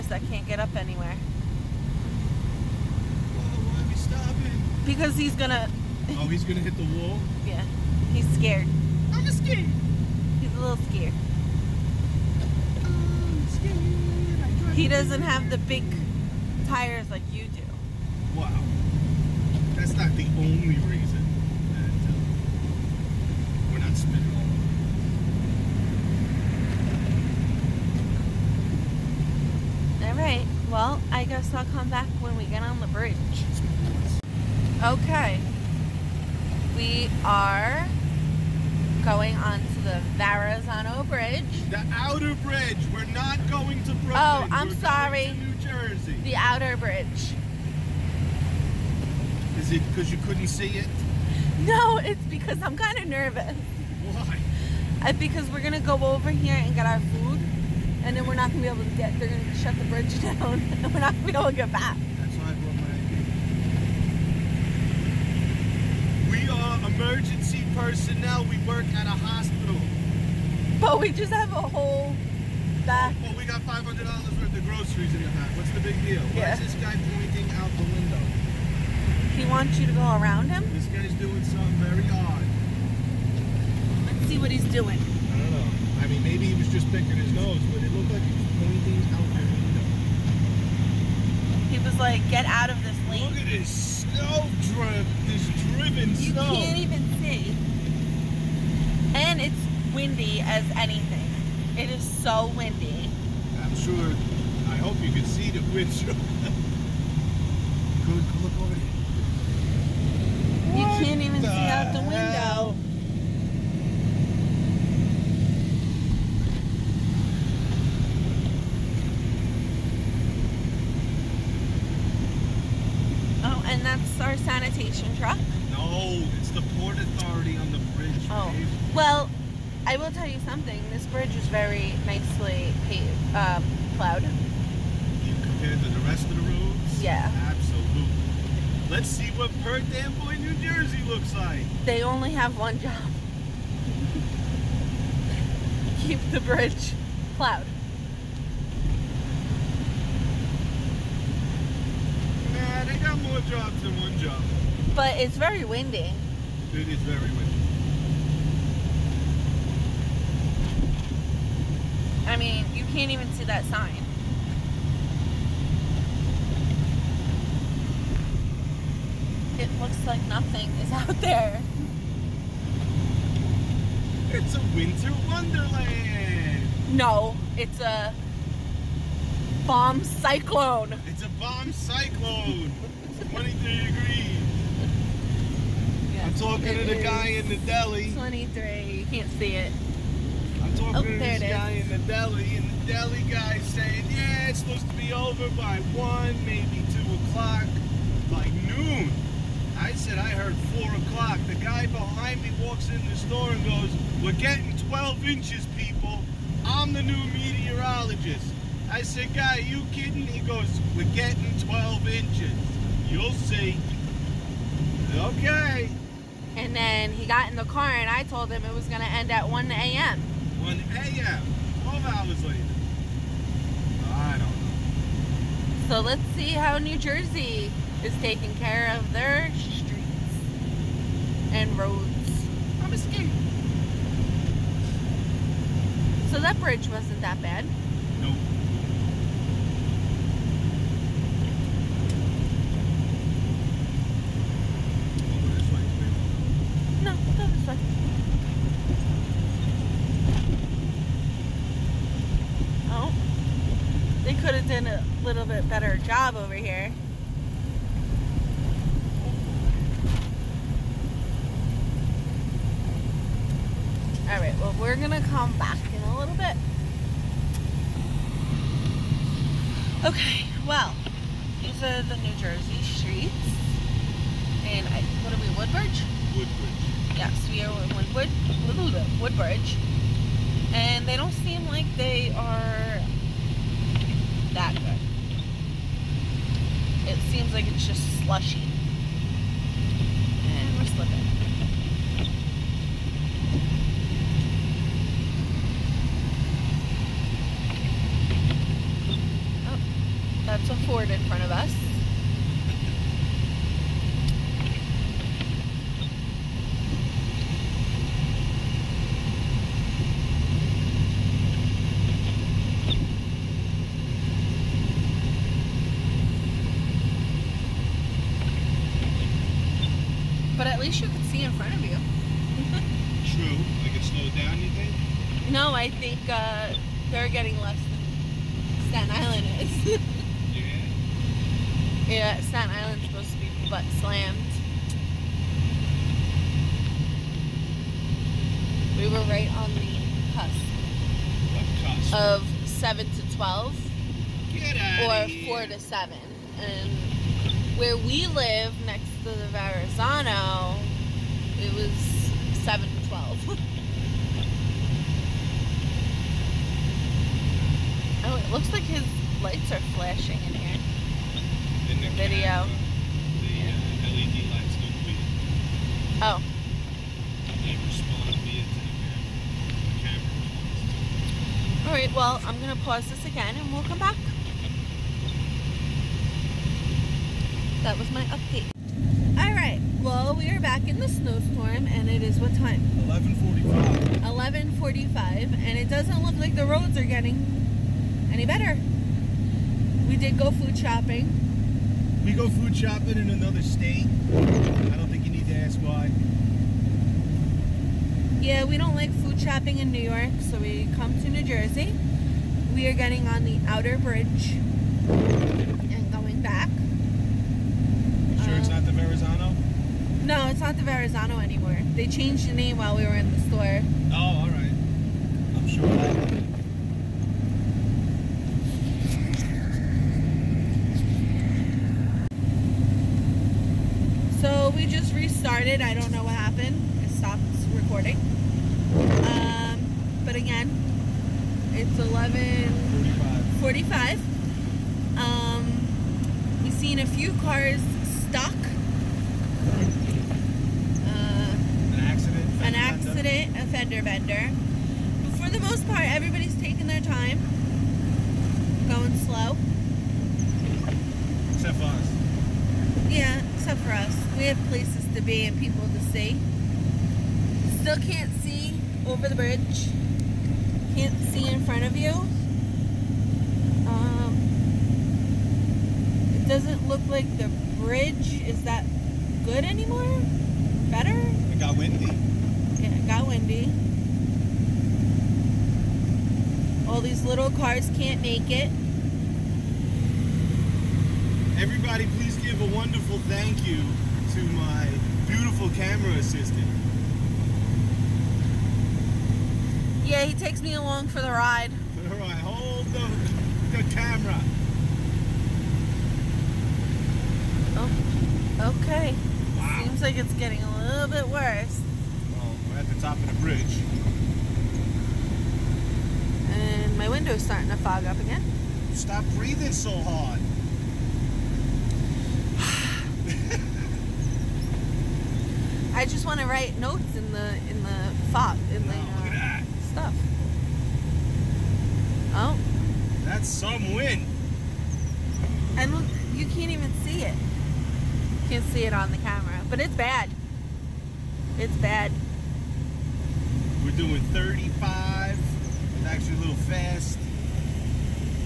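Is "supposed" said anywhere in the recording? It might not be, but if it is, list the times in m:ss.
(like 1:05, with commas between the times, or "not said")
3:14.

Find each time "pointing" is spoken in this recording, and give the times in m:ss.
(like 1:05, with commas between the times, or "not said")
1:17, 1:28.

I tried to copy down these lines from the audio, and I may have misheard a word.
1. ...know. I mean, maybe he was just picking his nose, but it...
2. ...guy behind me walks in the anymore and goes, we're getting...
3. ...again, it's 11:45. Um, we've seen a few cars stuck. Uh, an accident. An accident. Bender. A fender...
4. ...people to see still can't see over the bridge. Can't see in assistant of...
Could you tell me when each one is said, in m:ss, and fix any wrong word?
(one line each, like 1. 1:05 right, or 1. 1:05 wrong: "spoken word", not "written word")
1. 1:25 right
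2. 3:21 wrong: "store", not "anymore"
3. 7:10 right
4. 7:35 wrong: "front", not "assistant".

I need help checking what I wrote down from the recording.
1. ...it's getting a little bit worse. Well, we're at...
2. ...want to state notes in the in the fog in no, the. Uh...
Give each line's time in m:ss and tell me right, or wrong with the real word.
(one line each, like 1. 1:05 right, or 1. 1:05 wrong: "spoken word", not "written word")
1. 8:20 right
2. 8:36 wrong: "write", not "state".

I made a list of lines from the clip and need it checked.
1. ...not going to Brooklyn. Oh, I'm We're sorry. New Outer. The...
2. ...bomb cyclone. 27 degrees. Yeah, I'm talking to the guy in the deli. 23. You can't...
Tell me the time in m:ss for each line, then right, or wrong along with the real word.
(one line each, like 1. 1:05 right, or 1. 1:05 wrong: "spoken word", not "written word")
1. 0:43 wrong: "Jersey", not "Outer"
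2. 3:01 wrong: "23", not "27".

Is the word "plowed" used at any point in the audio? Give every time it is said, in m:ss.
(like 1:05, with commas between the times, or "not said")
2:13, 2:27.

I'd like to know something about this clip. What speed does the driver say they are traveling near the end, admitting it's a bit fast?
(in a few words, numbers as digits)
35.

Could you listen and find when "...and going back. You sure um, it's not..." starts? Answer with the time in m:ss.
6:44.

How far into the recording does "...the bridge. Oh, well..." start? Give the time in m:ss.
2:07.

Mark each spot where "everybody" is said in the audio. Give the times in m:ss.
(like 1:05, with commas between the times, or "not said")
7:26, 8:01.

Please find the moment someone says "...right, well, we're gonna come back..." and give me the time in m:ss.
4:24.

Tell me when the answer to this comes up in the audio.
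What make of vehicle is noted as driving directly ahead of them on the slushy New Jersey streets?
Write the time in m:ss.
5:00.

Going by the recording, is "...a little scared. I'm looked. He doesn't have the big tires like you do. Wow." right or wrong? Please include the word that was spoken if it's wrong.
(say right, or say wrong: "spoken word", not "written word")
wrong: "scared", not "looked".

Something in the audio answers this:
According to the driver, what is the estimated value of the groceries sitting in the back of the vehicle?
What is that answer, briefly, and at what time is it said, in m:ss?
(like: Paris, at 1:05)
$500, at 1:13.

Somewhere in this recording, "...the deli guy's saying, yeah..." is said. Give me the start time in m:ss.
3:12.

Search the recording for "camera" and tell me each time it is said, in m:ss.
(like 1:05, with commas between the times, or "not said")
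6:02, 8:05, 8:13, 8:49.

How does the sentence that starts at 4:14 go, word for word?
could have done a little bit better job over here.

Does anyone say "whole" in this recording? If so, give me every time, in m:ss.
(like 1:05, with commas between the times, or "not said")
1:11.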